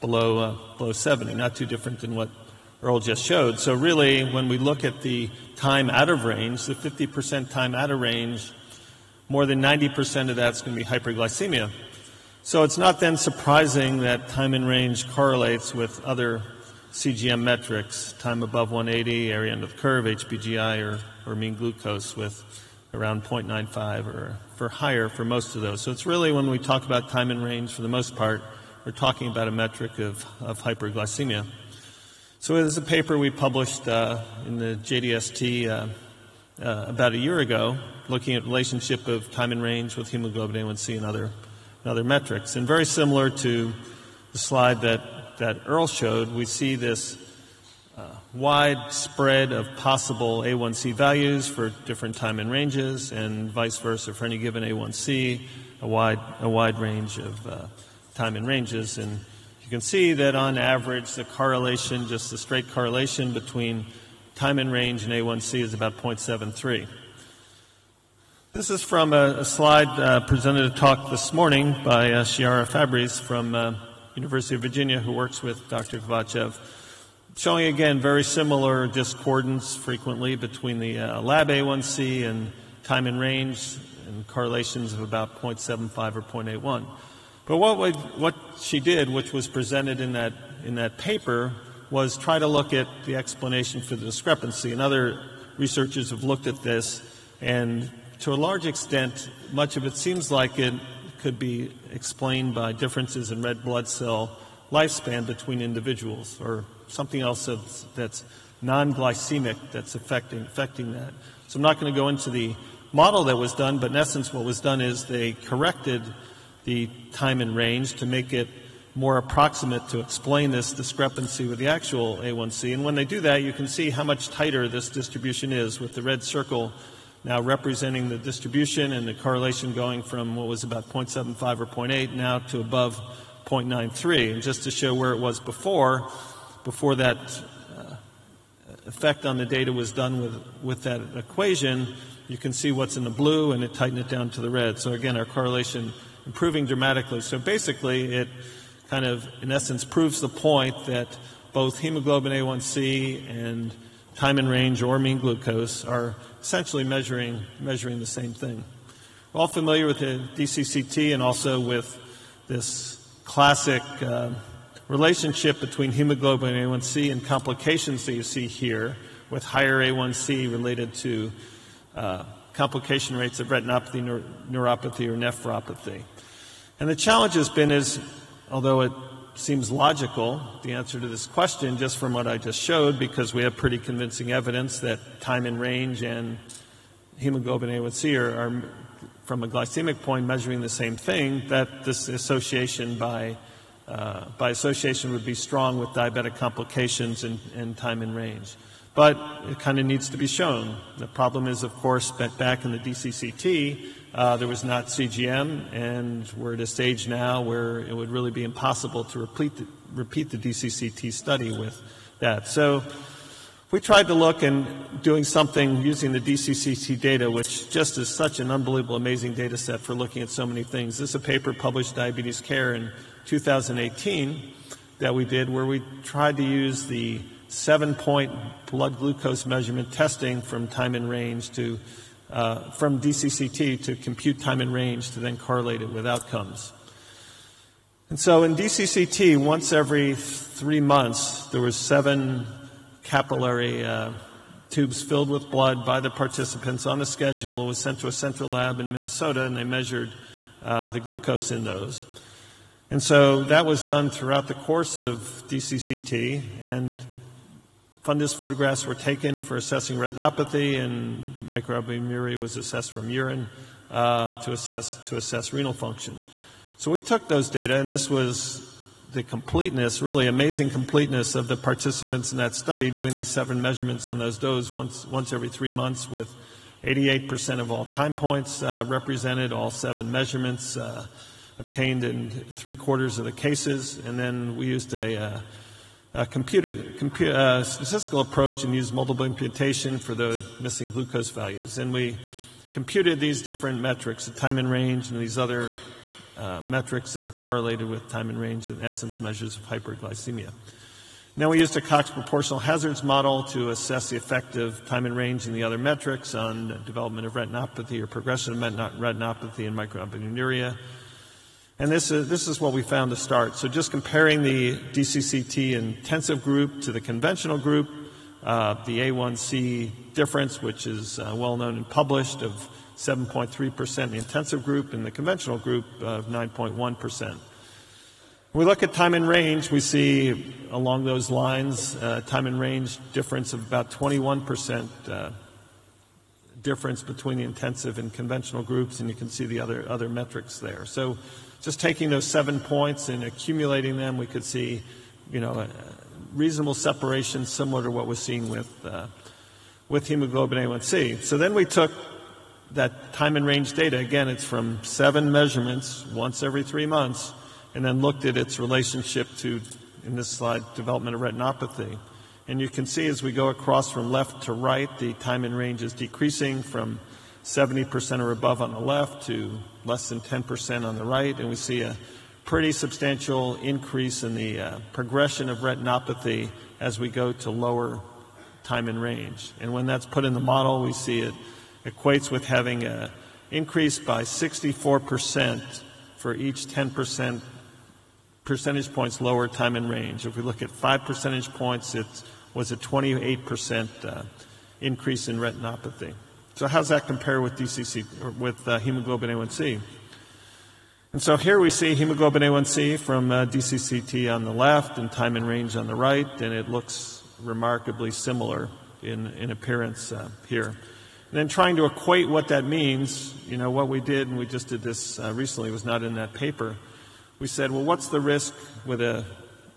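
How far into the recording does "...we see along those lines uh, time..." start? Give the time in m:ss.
5:29.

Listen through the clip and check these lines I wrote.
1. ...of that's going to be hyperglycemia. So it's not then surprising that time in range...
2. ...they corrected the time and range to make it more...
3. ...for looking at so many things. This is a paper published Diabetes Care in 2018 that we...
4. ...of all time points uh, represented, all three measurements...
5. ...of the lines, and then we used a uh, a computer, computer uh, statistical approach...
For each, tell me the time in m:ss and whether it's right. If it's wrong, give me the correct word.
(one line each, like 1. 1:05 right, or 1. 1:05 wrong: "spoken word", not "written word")
1. 0:10 right
2. 1:55 right
3. 3:39 right
4. 4:37 wrong: "seven", not "three"
5. 4:43 wrong: "cases", not "lines".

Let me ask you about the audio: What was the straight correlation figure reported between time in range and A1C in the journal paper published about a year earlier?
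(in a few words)
0.73.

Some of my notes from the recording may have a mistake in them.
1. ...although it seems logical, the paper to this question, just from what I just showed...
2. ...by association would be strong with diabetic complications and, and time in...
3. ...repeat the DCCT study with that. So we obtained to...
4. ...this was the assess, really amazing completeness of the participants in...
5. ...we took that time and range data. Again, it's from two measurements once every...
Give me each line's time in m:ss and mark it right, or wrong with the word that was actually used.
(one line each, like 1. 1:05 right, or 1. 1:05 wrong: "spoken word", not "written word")
1. 2:58 wrong: "answer", not "paper"
2. 3:14 right
3. 3:29 wrong: "tried", not "obtained"
4. 4:27 wrong: "completeness", not "assess"
5. 5:51 wrong: "seven", not "two".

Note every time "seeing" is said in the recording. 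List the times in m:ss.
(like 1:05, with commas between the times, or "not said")
5:48.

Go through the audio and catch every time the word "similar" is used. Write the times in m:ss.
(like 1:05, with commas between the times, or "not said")
0:42, 1:18, 5:47, 6:48.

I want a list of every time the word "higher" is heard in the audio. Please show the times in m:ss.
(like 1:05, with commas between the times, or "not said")
0:24, 2:49.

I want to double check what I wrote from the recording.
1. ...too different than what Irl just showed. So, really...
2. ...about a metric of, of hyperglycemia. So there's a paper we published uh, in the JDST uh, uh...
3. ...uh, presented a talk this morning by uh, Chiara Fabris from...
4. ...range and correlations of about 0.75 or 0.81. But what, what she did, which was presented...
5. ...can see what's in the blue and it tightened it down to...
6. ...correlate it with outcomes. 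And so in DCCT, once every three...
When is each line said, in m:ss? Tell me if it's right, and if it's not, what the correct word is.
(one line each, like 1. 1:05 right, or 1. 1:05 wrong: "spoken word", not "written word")
1. 0:01 right
2. 0:29 right
3. 1:09 right
4. 1:23 right
5. 2:22 right
6. 3:55 right.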